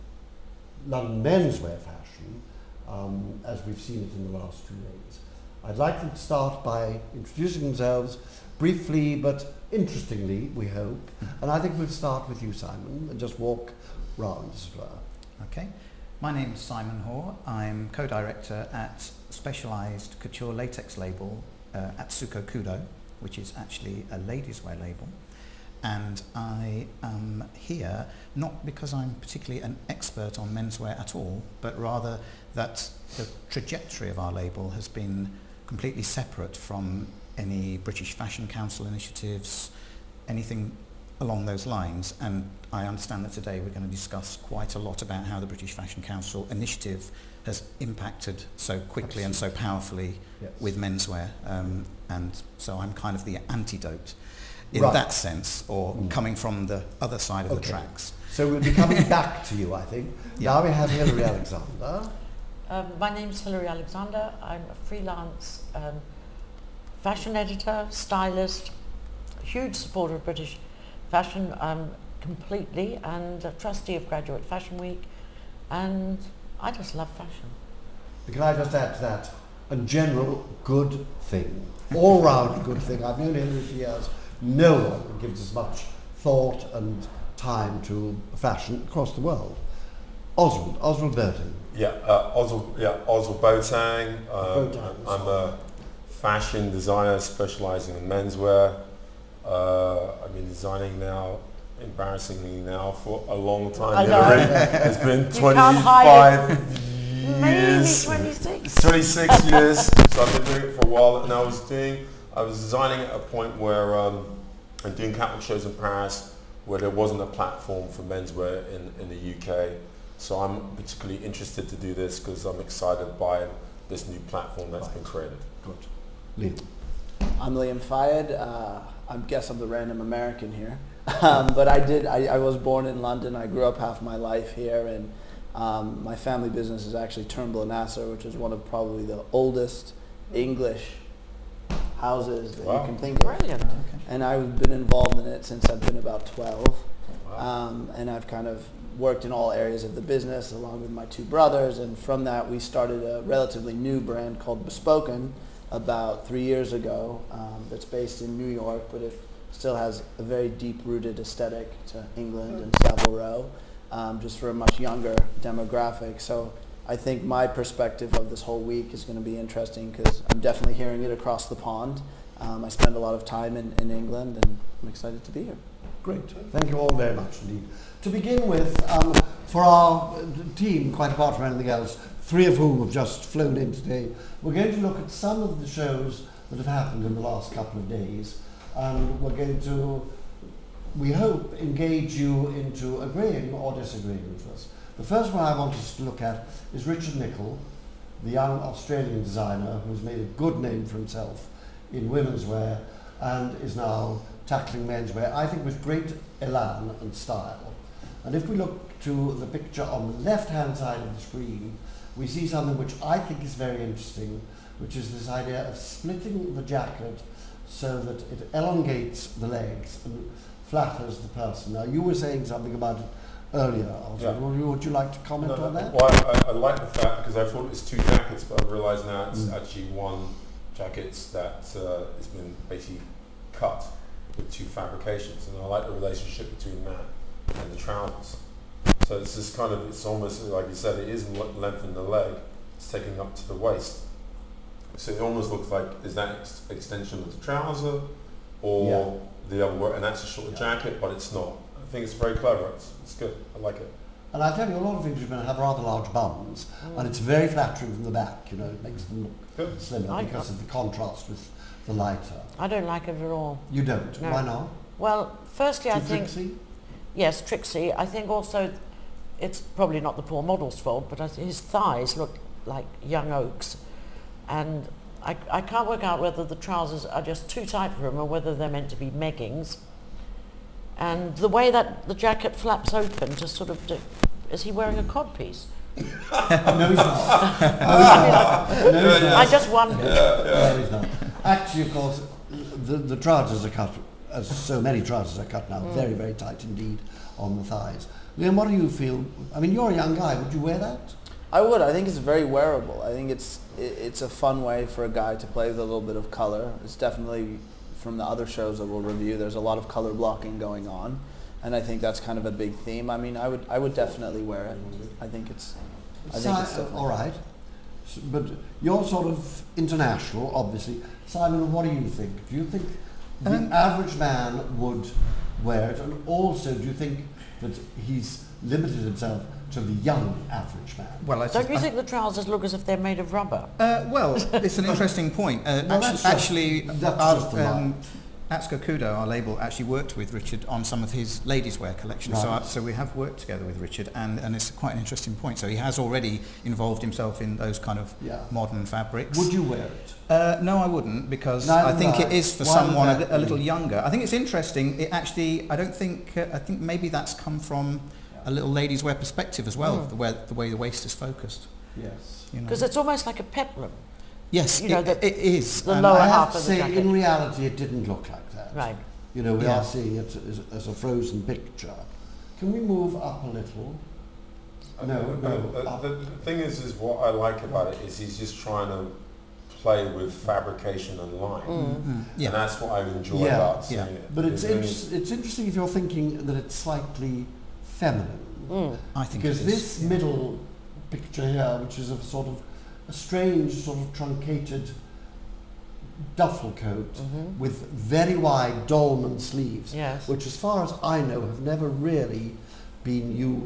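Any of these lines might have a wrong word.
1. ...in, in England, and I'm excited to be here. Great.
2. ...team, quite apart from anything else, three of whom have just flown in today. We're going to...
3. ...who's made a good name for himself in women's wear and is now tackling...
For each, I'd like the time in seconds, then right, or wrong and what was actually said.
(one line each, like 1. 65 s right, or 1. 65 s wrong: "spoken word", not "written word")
1. 173 s right
2. 180 s right
3. 199 s right.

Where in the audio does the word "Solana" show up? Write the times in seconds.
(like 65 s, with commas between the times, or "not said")
not said.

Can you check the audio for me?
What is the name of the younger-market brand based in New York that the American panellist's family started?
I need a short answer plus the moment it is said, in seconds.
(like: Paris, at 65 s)
Bespoken, at 154 s.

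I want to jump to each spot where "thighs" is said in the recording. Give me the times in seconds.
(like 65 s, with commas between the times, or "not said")
271 s, 297 s.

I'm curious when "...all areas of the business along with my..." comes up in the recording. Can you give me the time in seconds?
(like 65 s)
149 s.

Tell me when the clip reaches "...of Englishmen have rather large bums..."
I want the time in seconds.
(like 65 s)
254 s.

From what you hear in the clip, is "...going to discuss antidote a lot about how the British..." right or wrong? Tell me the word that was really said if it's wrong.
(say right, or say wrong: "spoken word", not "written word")
wrong: "quite", not "antidote".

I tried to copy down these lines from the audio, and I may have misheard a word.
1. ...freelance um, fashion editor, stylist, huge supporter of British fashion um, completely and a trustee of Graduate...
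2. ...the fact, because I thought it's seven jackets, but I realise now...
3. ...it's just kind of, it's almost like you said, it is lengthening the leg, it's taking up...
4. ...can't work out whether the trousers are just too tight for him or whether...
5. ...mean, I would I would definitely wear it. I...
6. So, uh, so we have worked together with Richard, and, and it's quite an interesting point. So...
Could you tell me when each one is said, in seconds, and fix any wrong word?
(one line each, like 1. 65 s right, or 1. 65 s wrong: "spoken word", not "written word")
1. 64 s right
2. 226 s wrong: "two", not "seven"
3. 239 s right
4. 275 s right
5. 313 s right
6. 342 s right.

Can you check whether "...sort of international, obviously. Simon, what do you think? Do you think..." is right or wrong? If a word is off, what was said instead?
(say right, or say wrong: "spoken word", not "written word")
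right.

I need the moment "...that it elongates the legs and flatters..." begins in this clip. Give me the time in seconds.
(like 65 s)
218 s.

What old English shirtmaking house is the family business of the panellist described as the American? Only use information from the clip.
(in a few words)
Turnbull and Asser.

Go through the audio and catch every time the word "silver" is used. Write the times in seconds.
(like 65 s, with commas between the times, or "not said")
not said.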